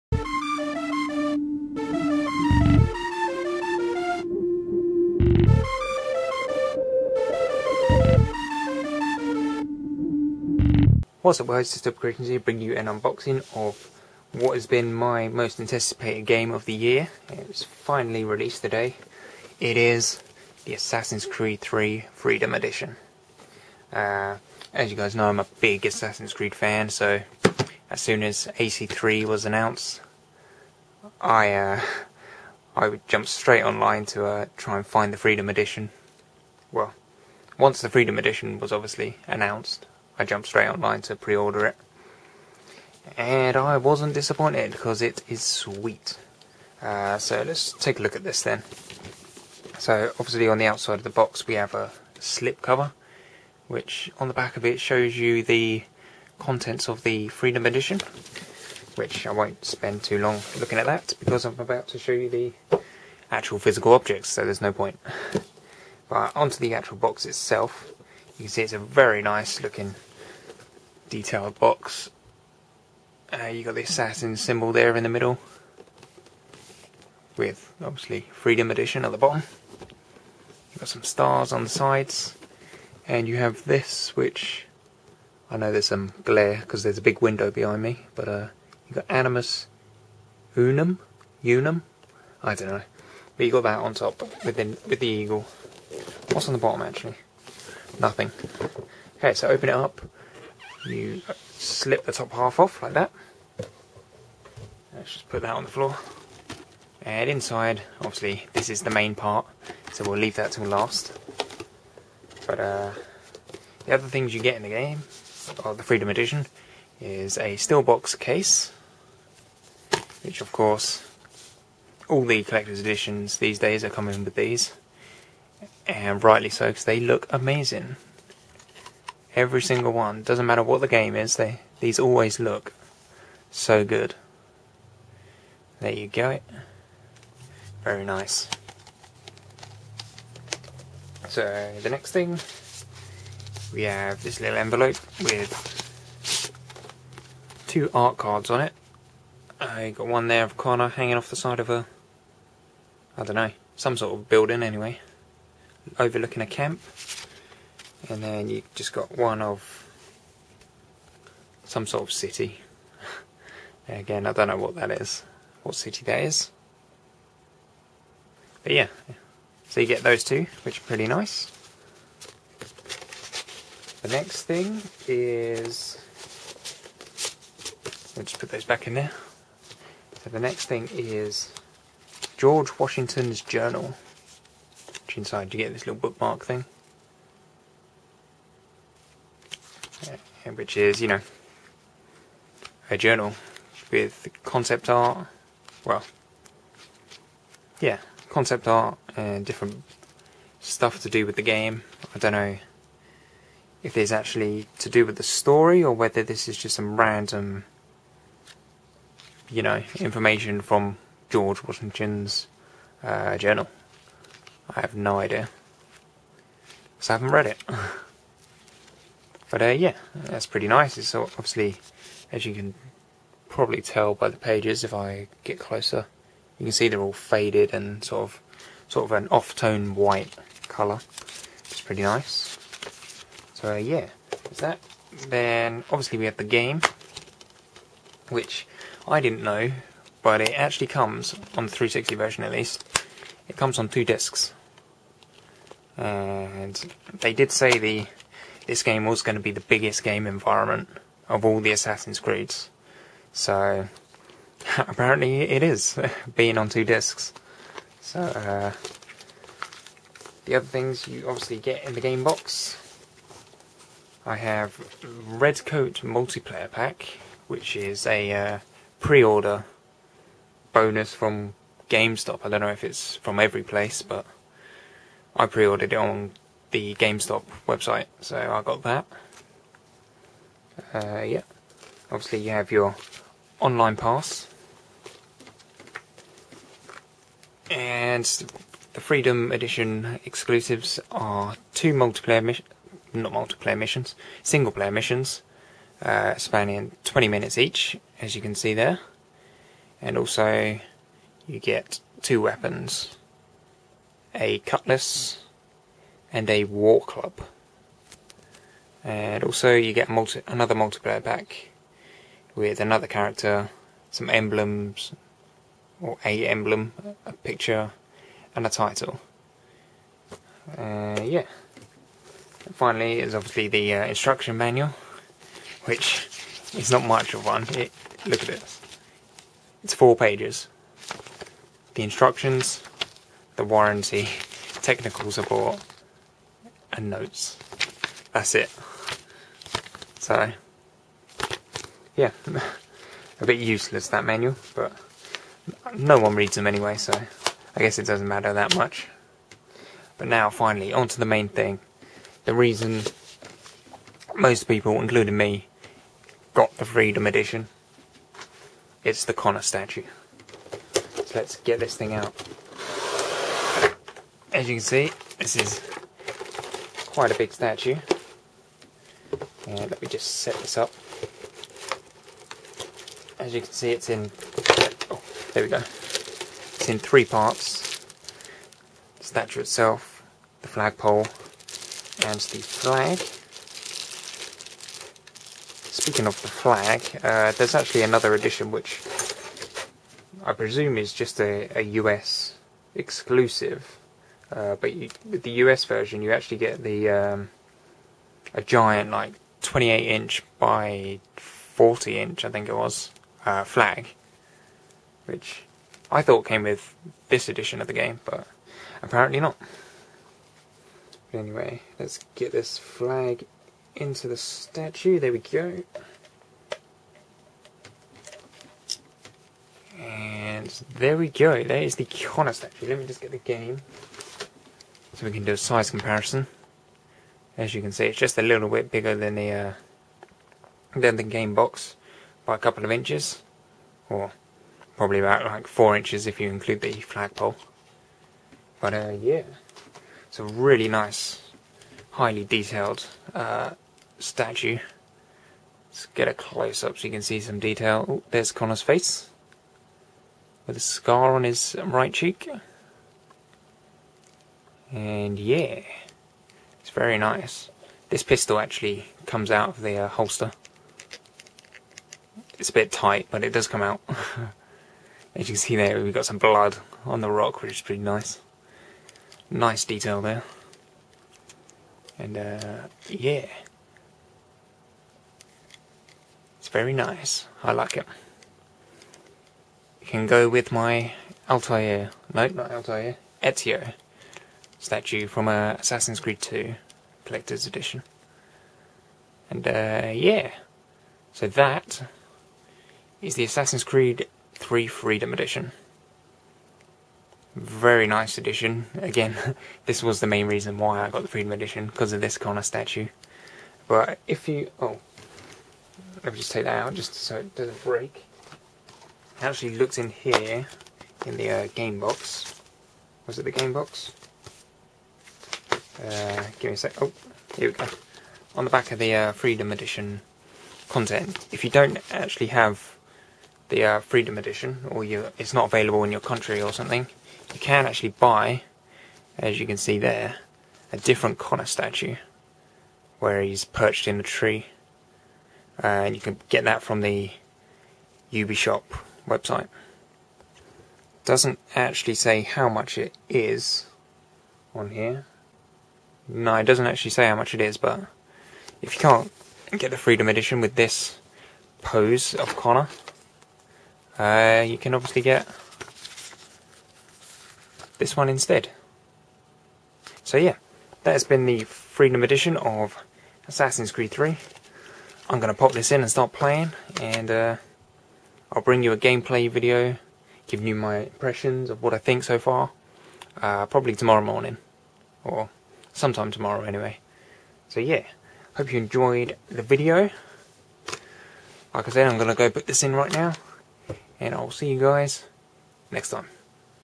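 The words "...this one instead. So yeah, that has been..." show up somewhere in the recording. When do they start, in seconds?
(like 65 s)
557 s.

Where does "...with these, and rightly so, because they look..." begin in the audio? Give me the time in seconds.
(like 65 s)
124 s.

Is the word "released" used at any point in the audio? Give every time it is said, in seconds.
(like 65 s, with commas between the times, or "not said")
18 s.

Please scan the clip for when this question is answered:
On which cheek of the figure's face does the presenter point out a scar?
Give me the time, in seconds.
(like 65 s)
451 s.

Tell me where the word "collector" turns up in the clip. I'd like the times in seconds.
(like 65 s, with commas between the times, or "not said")
122 s, 487 s.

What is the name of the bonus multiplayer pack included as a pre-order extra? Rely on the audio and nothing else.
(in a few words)
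Red Coat Multiplayer Pack.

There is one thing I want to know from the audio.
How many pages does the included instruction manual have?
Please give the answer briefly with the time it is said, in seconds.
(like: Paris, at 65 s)
4, at 329 s.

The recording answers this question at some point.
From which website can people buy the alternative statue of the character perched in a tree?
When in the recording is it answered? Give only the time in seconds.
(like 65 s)
538 s.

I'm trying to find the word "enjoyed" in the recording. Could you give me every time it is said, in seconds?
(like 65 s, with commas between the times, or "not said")
578 s.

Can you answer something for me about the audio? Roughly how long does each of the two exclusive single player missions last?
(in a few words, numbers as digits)
20 minutes.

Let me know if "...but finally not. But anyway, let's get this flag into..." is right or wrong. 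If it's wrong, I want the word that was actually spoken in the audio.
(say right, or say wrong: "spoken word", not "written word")
wrong: "apparently", not "finally".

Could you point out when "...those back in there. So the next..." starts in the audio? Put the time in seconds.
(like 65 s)
178 s.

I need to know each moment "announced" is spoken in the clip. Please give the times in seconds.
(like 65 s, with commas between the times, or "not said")
29 s, 39 s.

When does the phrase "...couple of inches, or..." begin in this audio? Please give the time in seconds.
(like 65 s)
432 s.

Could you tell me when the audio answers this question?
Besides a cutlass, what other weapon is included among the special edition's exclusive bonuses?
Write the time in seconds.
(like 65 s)
306 s.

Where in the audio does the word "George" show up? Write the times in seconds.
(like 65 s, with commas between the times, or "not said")
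182 s, 211 s.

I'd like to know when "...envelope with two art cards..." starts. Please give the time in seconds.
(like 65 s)
144 s.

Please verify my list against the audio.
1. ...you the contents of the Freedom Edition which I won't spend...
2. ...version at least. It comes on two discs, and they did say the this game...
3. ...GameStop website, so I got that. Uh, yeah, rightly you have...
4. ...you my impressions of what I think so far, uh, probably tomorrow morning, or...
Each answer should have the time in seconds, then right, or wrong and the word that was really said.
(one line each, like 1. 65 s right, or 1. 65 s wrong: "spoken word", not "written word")
1. 55 s right
2. 242 s right
3. 276 s wrong: "obviously", not "rightly"
4. 570 s right.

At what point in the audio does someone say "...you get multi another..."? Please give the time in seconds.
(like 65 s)
309 s.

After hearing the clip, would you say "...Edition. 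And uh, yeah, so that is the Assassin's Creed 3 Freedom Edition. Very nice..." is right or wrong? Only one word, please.
right.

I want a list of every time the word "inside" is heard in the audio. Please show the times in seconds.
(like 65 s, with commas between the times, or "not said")
107 s, 185 s.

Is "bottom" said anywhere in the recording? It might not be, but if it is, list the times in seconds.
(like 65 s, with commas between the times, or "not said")
79 s, 96 s.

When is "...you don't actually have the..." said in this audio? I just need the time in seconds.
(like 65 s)
521 s.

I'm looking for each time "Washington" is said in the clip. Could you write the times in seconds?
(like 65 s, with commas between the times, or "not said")
182 s, 211 s.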